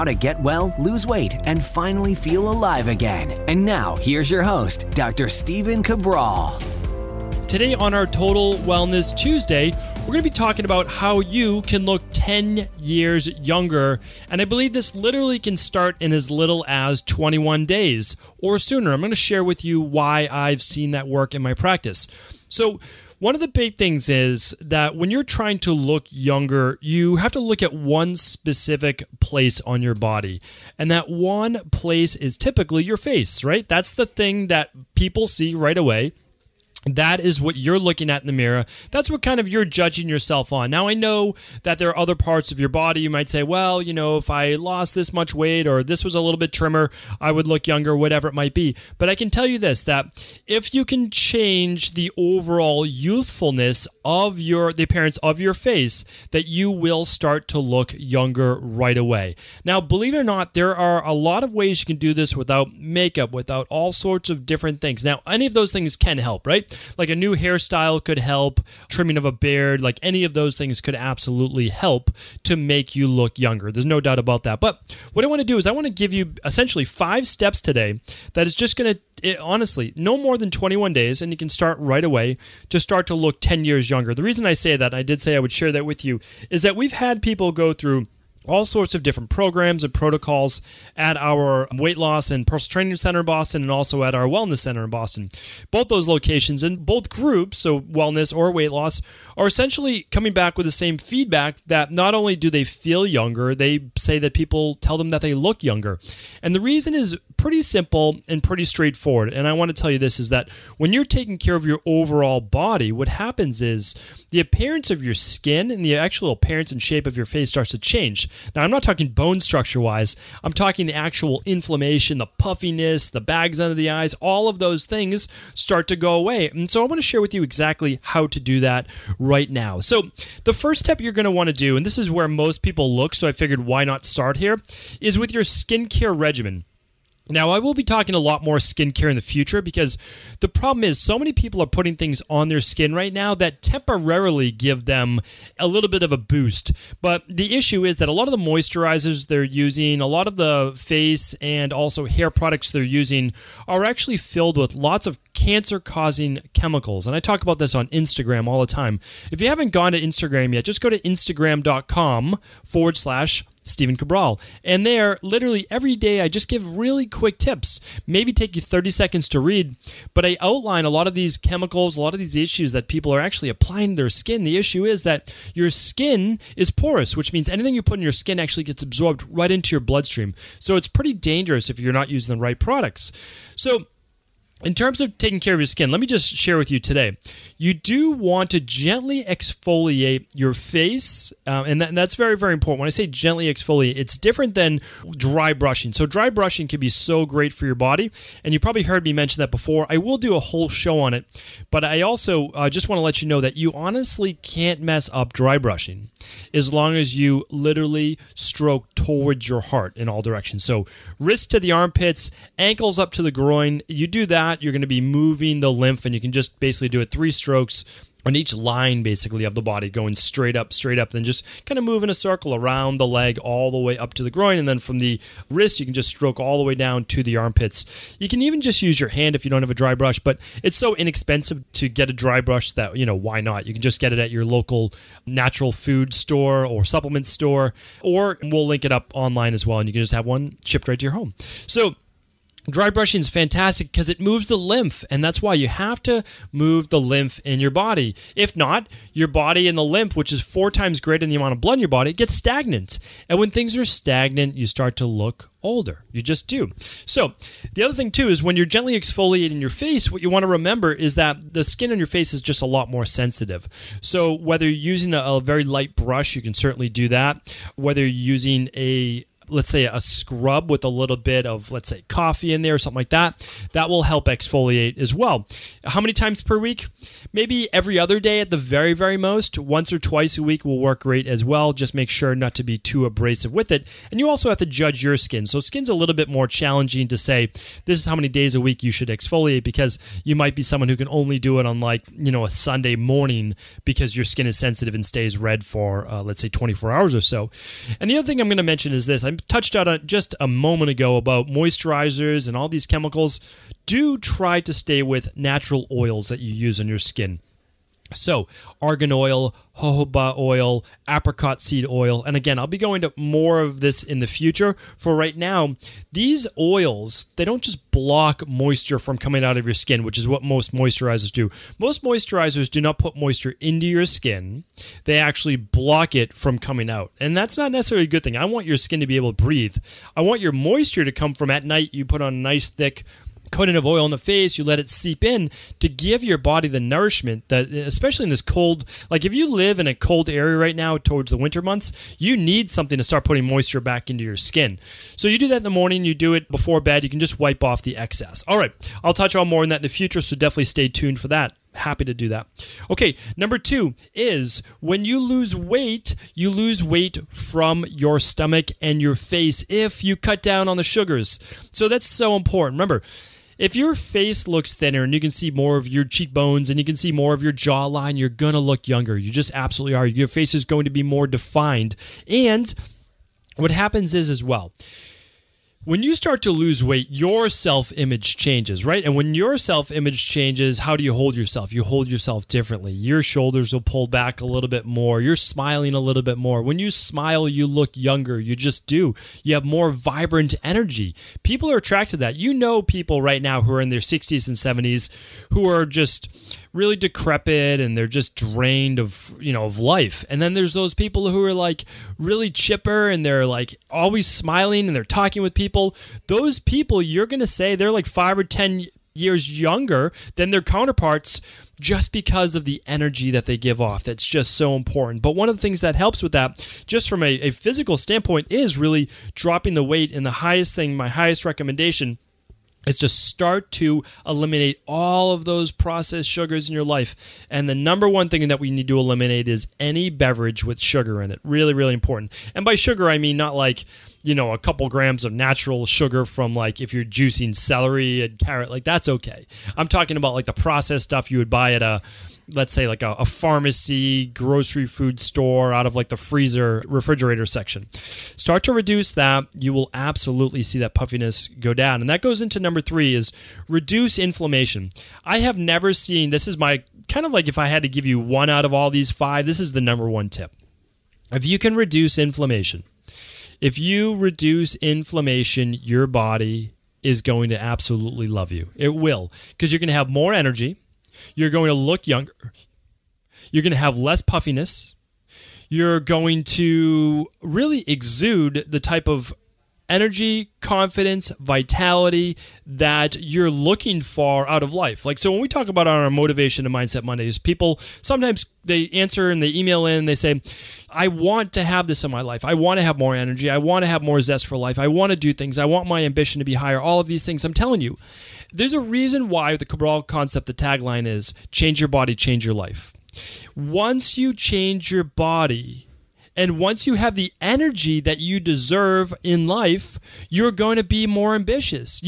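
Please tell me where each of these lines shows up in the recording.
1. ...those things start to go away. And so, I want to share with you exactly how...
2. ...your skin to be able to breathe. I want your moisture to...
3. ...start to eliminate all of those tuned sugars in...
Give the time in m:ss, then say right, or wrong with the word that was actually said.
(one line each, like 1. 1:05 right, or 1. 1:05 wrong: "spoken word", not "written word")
1. 2:04 right
2. 5:28 right
3. 7:03 wrong: "processed", not "tuned".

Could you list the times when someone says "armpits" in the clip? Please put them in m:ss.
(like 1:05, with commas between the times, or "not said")
3:31, 3:47.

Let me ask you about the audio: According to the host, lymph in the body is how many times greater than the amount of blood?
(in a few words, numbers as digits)
4.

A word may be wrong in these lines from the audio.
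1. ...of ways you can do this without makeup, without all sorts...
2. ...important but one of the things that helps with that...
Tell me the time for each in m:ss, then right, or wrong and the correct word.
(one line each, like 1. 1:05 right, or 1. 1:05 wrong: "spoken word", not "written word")
1. 1:01 right
2. 6:54 right.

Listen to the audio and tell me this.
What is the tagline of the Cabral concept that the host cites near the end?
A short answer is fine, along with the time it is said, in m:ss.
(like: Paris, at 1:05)
change your body, change your life, at 8:21.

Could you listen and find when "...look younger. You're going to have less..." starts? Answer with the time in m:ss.
7:51.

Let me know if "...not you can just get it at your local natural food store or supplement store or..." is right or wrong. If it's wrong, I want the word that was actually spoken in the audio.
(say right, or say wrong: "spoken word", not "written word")
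right.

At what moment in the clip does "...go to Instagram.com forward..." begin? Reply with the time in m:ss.
2:40.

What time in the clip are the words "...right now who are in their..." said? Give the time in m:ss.
6:33.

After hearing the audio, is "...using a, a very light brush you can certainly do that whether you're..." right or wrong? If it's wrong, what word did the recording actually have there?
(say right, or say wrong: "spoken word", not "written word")
right.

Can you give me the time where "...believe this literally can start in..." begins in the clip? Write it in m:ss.
0:14.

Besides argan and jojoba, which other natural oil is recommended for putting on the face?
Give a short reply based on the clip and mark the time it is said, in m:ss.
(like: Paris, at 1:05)
apricot seed oil, at 5:11.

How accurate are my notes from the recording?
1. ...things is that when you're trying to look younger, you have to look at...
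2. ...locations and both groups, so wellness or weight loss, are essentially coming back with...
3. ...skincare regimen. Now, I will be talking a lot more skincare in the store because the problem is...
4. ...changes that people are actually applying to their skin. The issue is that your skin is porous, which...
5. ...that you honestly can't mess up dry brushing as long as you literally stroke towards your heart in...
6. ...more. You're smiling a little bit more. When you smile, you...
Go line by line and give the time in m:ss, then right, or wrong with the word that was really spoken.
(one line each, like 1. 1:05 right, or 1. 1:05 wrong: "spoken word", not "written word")
1. 0:23 right
2. 1:36 right
3. 2:15 wrong: "future", not "store"
4. 2:52 wrong: "issues", not "changes"
5. 3:23 right
6. 6:24 right.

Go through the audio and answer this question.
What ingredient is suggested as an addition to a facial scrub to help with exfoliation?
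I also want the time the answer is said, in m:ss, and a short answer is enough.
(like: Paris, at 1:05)
coffee, at 4:32.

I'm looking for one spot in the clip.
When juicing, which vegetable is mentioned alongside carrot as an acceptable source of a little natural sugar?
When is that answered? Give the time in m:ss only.
7:17.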